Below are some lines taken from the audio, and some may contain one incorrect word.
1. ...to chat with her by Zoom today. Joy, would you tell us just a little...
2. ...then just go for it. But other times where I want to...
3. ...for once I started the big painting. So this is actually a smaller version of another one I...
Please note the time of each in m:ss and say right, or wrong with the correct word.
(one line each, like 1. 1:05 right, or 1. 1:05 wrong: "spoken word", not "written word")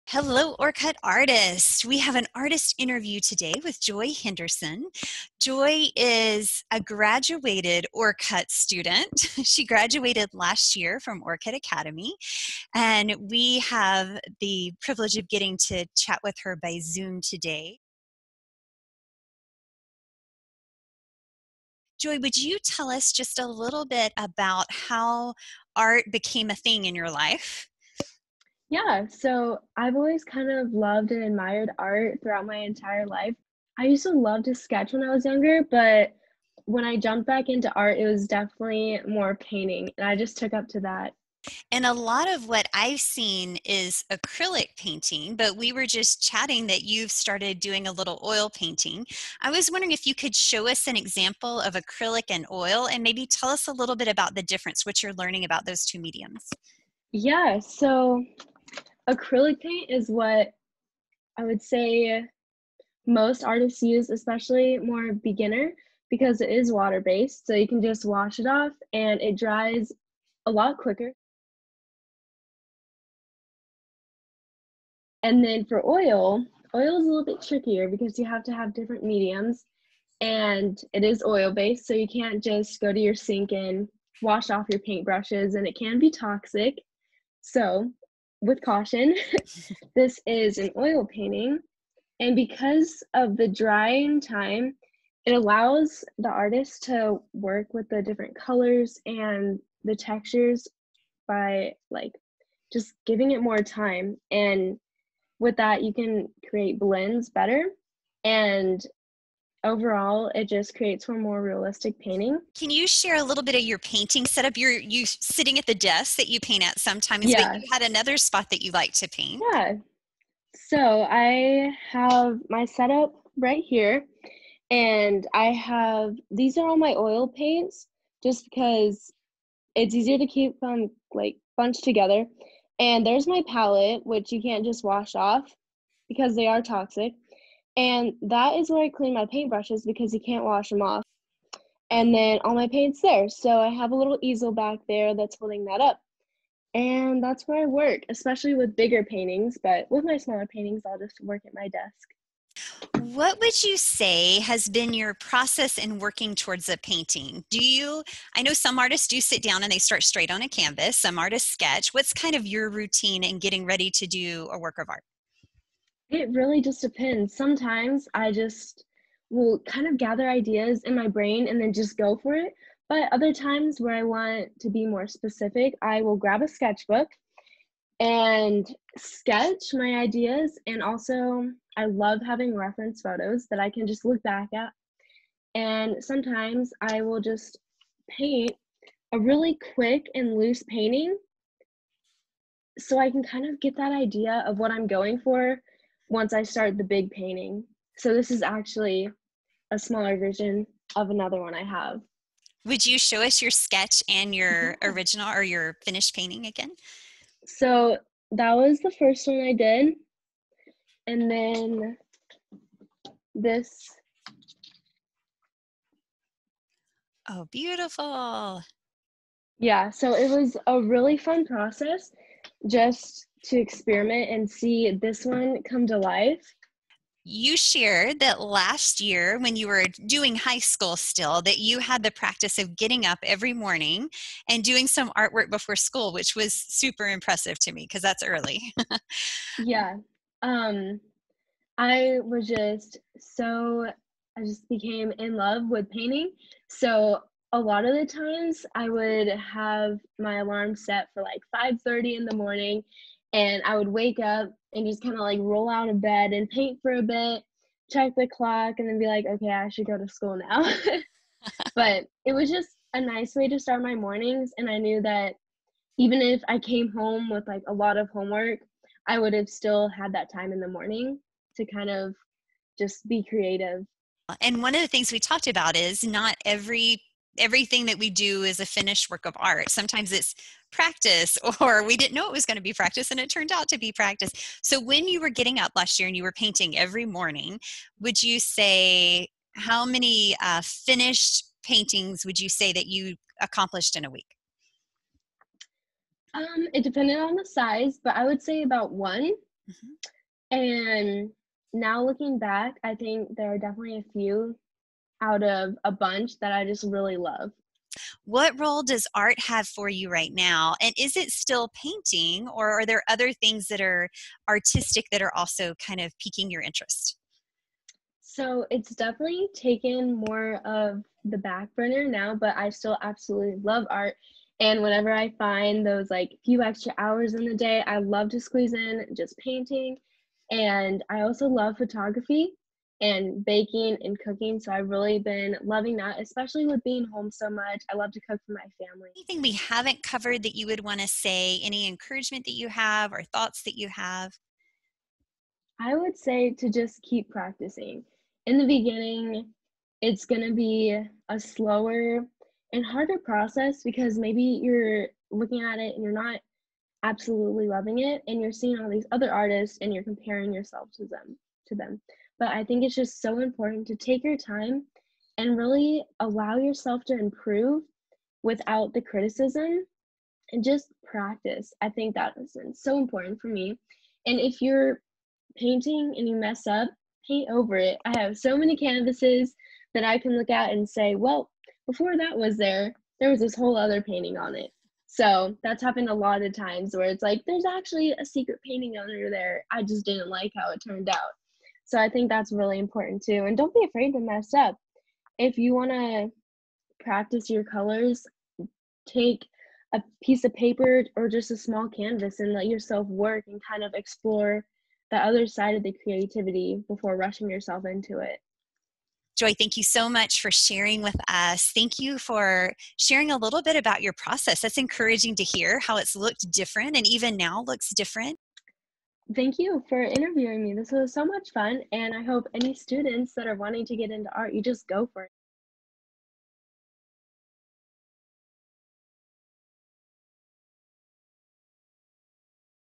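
1. 0:15 right
2. 2:51 right
3. 3:15 right.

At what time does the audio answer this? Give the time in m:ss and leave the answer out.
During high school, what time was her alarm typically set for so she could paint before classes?
4:11.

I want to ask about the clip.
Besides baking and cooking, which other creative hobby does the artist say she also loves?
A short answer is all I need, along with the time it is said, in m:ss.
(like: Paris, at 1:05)
Photography, at 5:31.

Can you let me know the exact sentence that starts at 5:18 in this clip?
So it's definitely taken more of the back burner now, but I still absolutely love art.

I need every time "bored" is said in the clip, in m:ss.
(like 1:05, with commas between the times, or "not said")
not said.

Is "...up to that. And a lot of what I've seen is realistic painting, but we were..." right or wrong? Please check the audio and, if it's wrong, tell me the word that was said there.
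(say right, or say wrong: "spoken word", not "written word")
wrong: "acrylic", not "realistic".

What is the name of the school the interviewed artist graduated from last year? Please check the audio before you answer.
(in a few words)
Orcutt Academy.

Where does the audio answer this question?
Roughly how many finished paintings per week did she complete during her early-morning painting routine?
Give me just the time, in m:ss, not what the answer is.
4:58.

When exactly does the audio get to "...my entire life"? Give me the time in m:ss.
0:32.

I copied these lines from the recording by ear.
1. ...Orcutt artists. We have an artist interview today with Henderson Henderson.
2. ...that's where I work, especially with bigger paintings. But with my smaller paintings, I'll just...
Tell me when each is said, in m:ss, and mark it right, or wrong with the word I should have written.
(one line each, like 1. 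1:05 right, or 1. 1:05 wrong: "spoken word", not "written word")
1. 0:00 wrong: "Joy", not "Henderson"
2. 2:27 right.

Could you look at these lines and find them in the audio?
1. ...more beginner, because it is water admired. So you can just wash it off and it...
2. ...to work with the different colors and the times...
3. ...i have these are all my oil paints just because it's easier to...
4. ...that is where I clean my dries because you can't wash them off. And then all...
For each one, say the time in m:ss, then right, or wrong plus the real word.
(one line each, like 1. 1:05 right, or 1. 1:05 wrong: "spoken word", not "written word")
1. 1:04 wrong: "based", not "admired"
2. 1:36 wrong: "textures", not "times"
3. 2:05 right
4. 2:18 wrong: "paintbrushes", not "dries".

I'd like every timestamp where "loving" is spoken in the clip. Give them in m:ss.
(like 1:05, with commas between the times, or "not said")
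5:35, 5:57.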